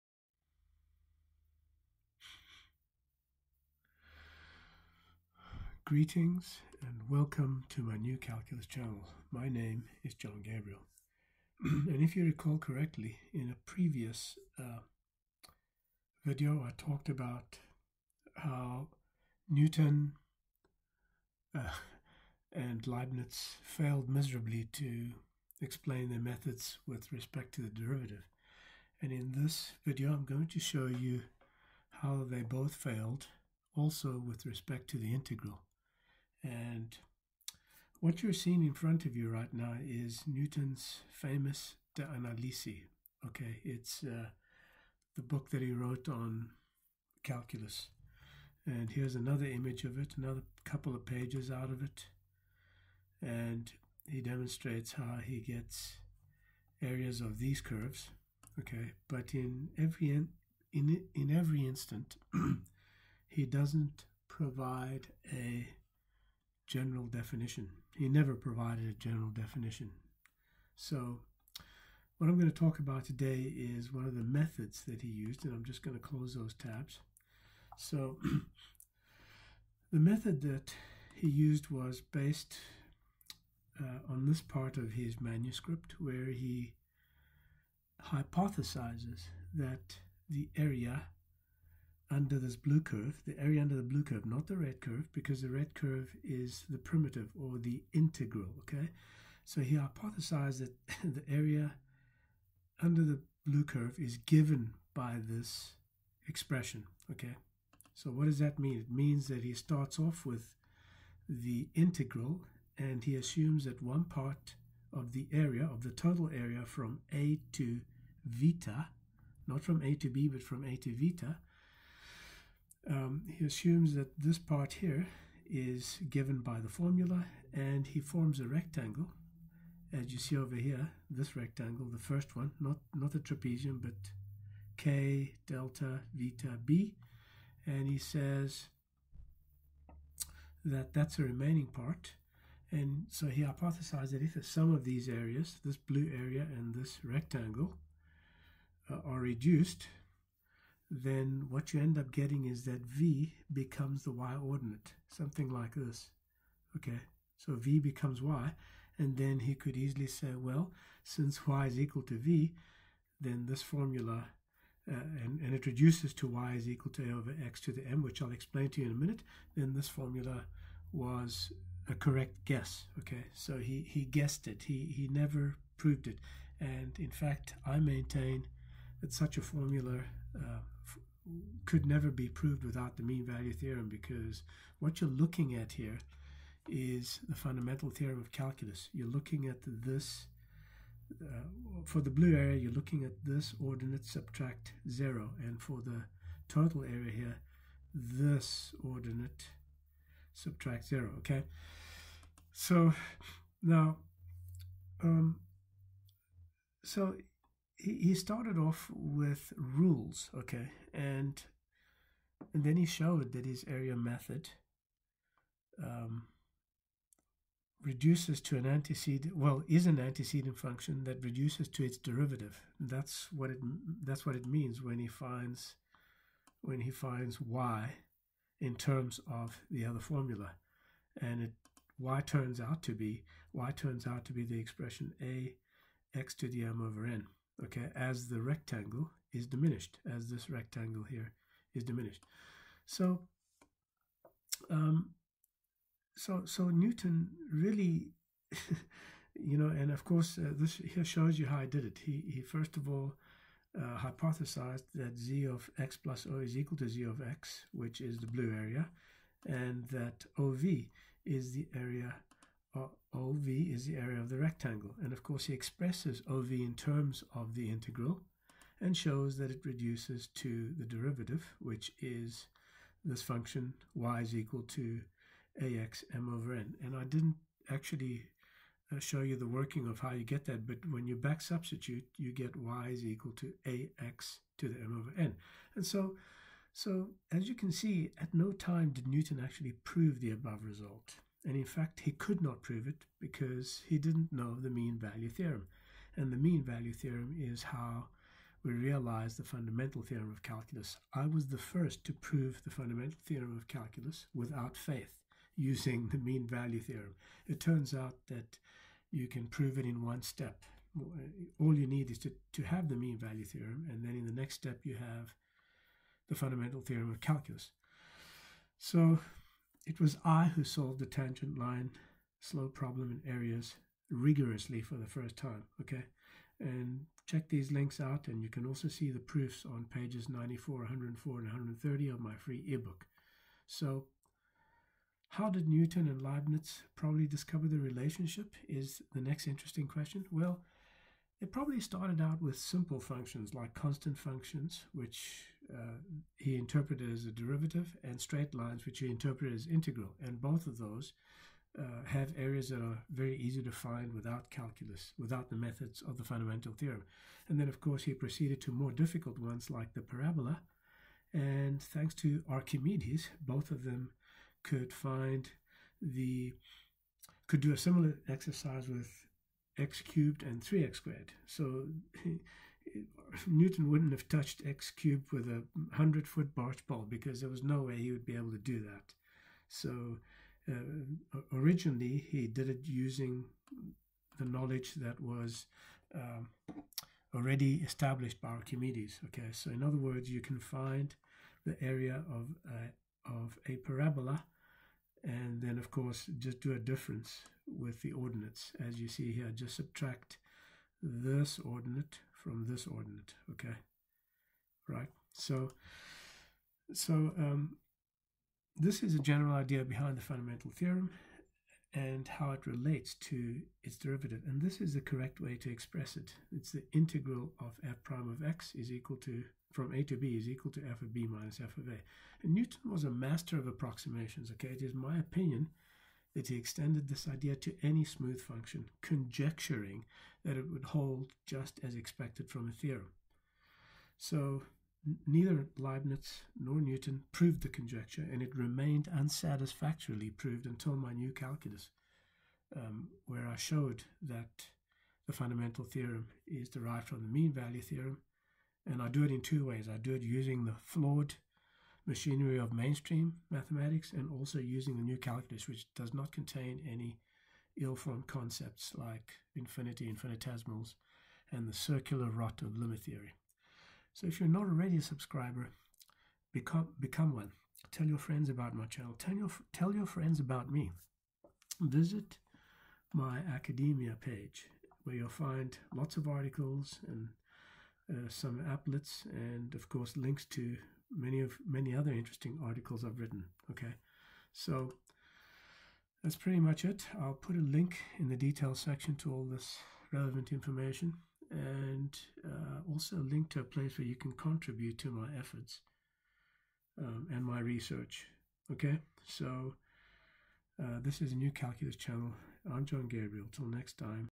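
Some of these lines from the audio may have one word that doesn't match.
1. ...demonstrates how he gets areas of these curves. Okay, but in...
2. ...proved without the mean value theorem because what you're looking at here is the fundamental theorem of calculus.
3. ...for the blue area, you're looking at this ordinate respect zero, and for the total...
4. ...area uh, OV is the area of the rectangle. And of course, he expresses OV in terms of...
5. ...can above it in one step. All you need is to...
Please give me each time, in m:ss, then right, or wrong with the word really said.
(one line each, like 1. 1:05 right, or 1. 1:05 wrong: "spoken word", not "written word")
1. 0:54 right
2. 3:02 right
3. 3:11 wrong: "subtract", not "respect"
4. 4:21 right
5. 5:09 wrong: "prove", not "above".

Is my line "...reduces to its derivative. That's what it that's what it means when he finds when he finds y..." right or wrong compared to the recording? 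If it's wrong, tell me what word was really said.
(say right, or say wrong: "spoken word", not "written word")
right.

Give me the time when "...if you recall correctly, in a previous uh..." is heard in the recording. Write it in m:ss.
0:12.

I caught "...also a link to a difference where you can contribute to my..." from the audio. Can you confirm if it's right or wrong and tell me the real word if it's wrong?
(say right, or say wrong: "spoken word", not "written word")
wrong: "place", not "difference".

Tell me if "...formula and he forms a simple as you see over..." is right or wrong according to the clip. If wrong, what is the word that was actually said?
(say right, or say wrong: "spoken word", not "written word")
wrong: "rectangle", not "simple".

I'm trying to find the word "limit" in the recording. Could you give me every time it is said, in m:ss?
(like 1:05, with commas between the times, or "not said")
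7:42.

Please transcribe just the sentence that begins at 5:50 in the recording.
And both of those uh, have areas that are very easy to find without calculus, without the methods of the fundamental theorem.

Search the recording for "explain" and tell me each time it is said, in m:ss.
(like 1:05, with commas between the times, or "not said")
0:25, 2:48.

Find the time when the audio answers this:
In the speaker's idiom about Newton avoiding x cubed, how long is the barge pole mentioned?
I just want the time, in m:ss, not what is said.
6:15.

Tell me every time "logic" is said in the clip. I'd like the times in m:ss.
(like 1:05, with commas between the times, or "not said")
not said.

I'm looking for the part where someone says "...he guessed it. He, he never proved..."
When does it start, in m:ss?
2:53.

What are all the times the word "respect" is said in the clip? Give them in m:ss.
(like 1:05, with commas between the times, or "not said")
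0:27, 0:34.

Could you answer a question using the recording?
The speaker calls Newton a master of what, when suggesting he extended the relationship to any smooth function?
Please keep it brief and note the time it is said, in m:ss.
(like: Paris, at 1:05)
approximations, at 7:03.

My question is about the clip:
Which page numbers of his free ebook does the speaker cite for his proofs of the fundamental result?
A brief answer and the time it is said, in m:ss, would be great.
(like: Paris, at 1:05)
94, 104, and 130, at 5:30.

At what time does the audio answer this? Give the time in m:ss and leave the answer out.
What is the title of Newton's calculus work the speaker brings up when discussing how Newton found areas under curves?
0:41.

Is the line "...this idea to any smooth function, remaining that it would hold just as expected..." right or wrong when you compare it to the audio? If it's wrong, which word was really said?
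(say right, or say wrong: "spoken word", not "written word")
wrong: "conjecturing", not "remaining".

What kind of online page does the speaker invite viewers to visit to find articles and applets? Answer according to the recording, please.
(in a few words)
academia page.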